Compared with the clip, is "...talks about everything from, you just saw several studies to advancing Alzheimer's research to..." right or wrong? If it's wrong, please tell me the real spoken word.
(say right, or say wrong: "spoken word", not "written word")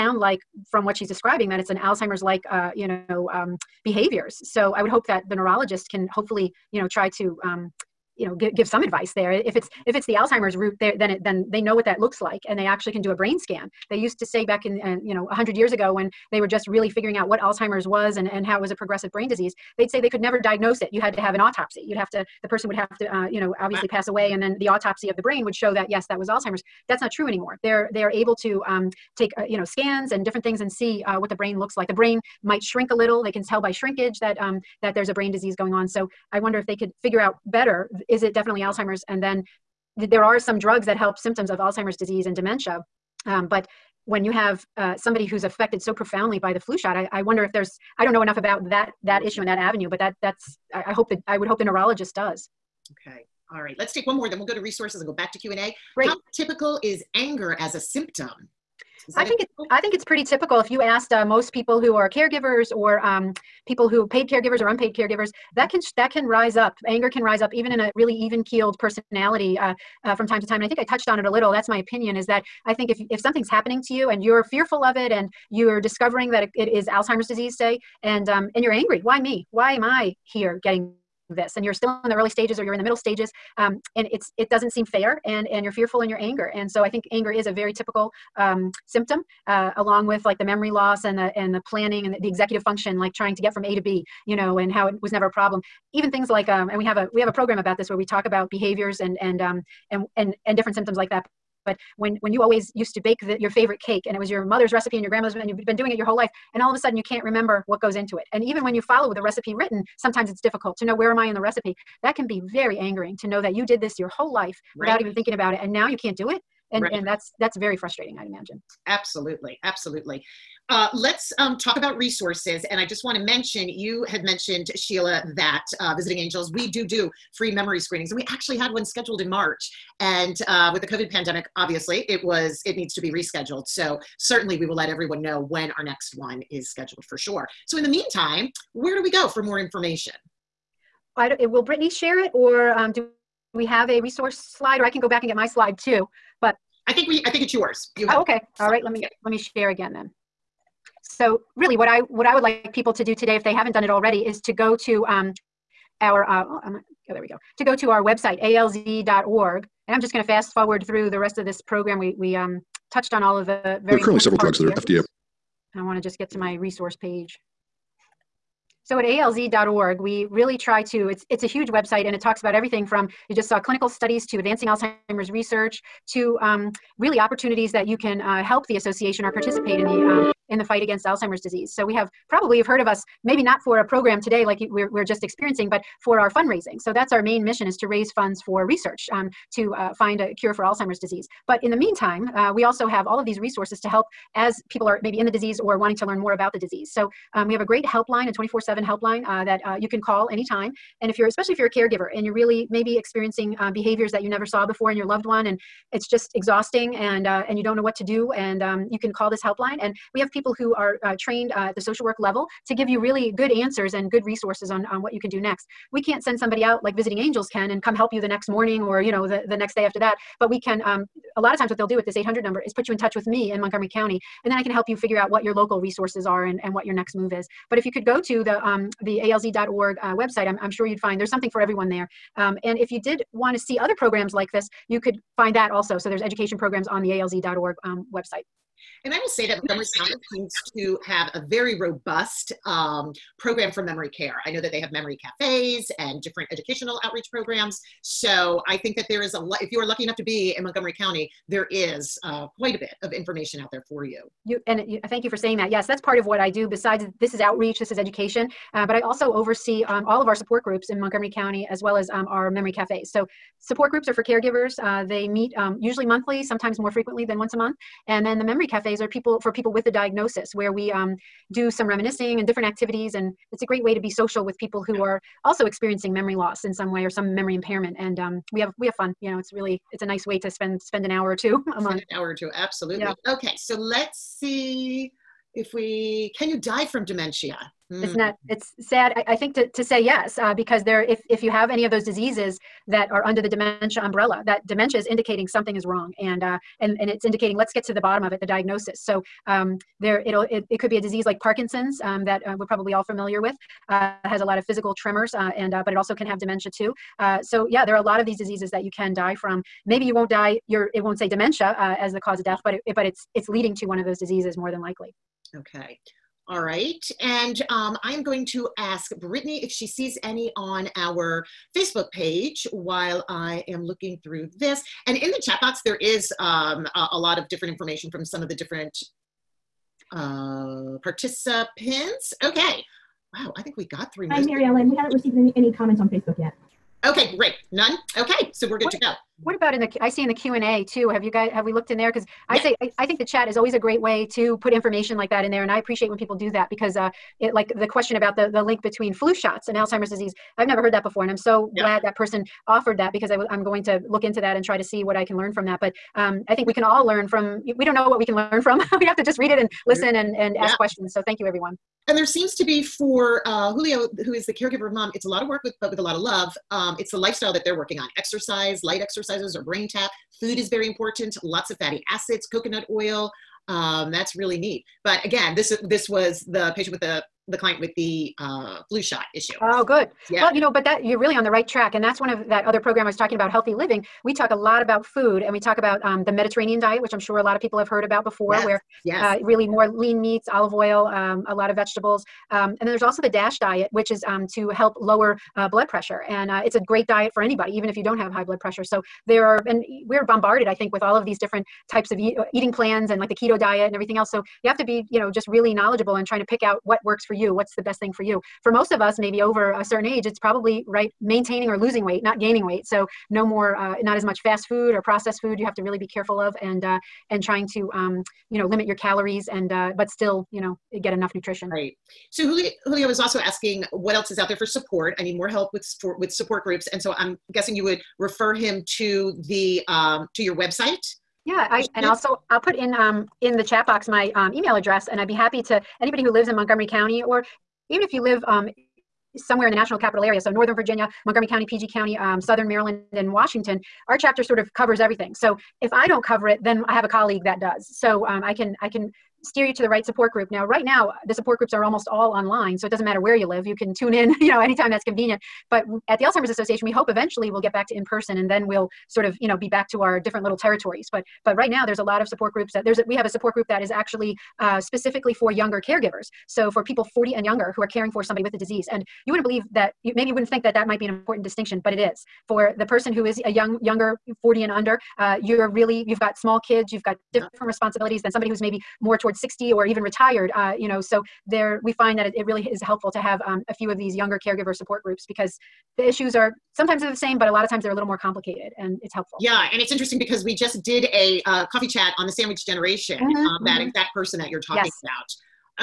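wrong: "clinical", not "several".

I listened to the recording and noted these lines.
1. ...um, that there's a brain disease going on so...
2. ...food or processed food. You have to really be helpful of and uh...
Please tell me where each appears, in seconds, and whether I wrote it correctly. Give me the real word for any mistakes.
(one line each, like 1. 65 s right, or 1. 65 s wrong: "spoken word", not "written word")
1. 34 s right
2. 414 s wrong: "careful", not "helpful".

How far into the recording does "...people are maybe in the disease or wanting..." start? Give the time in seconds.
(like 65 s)
194 s.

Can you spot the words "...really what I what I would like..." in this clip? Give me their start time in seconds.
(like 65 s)
151 s.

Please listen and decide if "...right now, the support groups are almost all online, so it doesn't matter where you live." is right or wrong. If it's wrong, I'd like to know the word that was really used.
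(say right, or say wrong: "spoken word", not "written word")
right.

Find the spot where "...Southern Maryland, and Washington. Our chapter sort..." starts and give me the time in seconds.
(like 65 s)
442 s.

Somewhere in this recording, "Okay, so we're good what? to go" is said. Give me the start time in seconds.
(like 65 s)
338 s.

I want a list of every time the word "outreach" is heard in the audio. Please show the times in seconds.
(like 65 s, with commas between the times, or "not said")
247 s, 257 s.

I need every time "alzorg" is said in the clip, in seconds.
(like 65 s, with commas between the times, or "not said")
158 s, 169 s, 229 s, 237 s.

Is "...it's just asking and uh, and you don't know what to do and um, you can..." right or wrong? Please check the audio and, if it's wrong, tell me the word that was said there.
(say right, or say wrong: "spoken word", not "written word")
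wrong: "exhausting", not "asking".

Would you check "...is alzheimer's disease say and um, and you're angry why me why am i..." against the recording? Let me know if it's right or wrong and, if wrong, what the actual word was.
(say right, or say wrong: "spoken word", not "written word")
right.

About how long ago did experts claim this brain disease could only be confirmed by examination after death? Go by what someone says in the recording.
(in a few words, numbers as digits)
100 years ago.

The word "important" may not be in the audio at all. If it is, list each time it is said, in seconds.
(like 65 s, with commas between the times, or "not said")
370 s, 471 s.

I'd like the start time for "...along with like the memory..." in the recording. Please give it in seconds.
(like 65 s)
89 s.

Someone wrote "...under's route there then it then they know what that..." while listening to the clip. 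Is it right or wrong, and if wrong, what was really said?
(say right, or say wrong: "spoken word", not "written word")
wrong: "alzheimer", not "under".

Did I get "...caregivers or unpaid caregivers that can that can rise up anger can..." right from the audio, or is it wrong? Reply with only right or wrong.
right.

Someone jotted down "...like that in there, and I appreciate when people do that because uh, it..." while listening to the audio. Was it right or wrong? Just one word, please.
right.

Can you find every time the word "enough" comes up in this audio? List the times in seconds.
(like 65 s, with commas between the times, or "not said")
48 s, 250 s, 421 s.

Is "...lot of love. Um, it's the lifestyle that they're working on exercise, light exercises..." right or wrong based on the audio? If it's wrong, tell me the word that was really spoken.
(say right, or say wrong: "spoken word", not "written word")
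right.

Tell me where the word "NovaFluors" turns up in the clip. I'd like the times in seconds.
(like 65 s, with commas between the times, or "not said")
not said.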